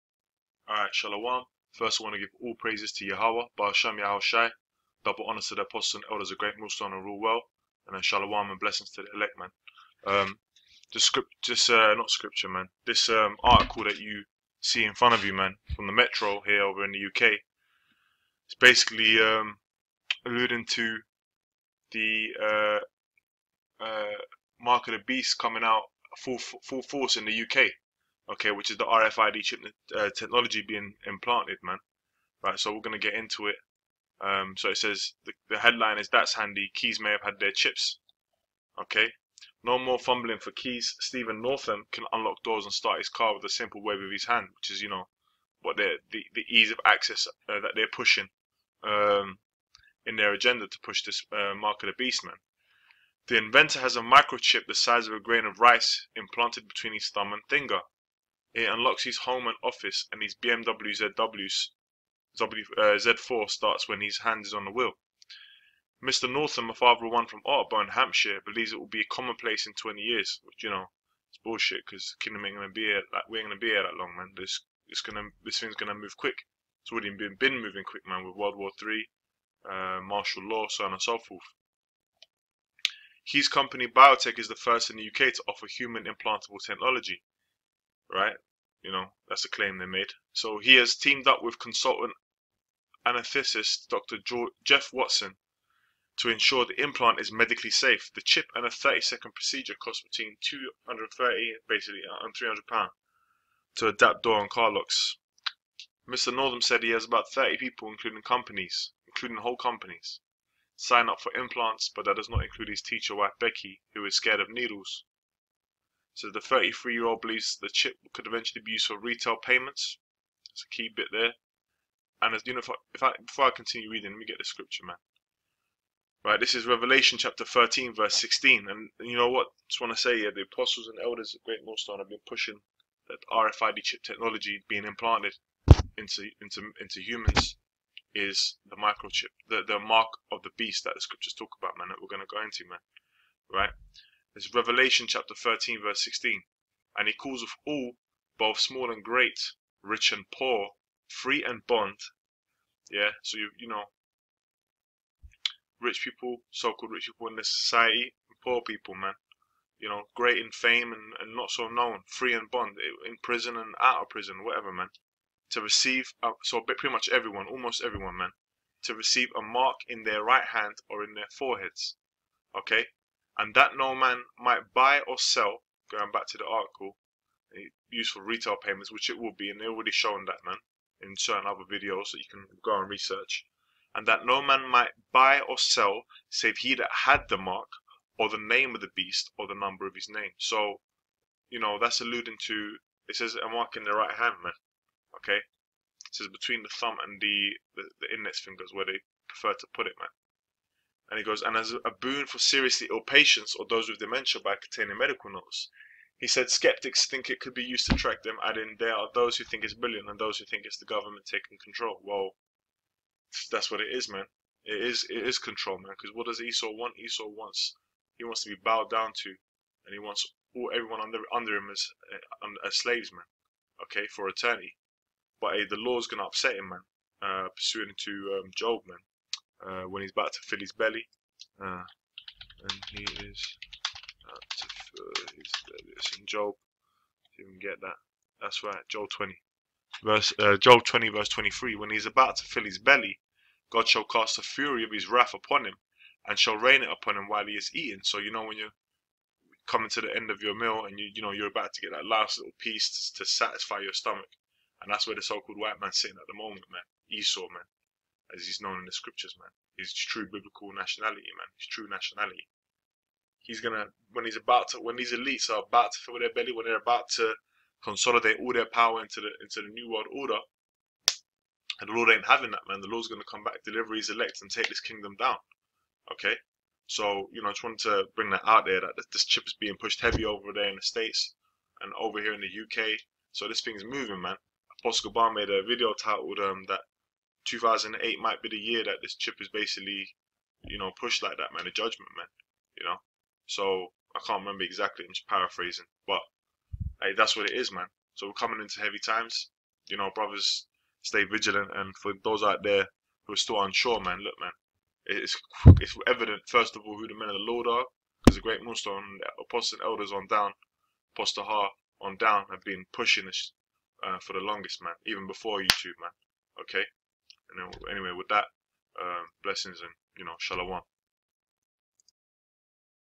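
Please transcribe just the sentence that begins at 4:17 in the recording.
Esau, man as he's known in the scriptures, man.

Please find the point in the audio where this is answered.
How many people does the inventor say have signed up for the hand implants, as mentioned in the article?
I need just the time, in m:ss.
1:47.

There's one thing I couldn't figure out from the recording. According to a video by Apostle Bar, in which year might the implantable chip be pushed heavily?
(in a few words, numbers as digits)
2008.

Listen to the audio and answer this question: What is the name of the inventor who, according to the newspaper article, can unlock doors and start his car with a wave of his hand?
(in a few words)
Stephen Northam.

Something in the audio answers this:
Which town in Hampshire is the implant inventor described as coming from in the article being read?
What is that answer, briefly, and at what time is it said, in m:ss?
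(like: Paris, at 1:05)
Otterbourne, at 1:07.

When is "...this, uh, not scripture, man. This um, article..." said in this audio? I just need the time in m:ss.
0:11.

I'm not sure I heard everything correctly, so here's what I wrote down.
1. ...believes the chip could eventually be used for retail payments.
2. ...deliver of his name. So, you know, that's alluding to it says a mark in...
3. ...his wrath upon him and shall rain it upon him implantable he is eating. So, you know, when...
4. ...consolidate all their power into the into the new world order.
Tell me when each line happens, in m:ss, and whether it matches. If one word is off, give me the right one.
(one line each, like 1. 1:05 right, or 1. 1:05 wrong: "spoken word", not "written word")
1. 1:57 right
2. 3:09 wrong: "number", not "deliver"
3. 4:04 wrong: "while", not "implantable"
4. 4:27 right.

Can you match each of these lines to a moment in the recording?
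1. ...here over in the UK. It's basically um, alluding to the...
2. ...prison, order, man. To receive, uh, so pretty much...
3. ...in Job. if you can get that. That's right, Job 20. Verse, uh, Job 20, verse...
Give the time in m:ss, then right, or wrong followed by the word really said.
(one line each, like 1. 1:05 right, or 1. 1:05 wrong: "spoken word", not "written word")
1. 0:16 right
2. 2:44 wrong: "whatever", not "order"
3. 3:56 right.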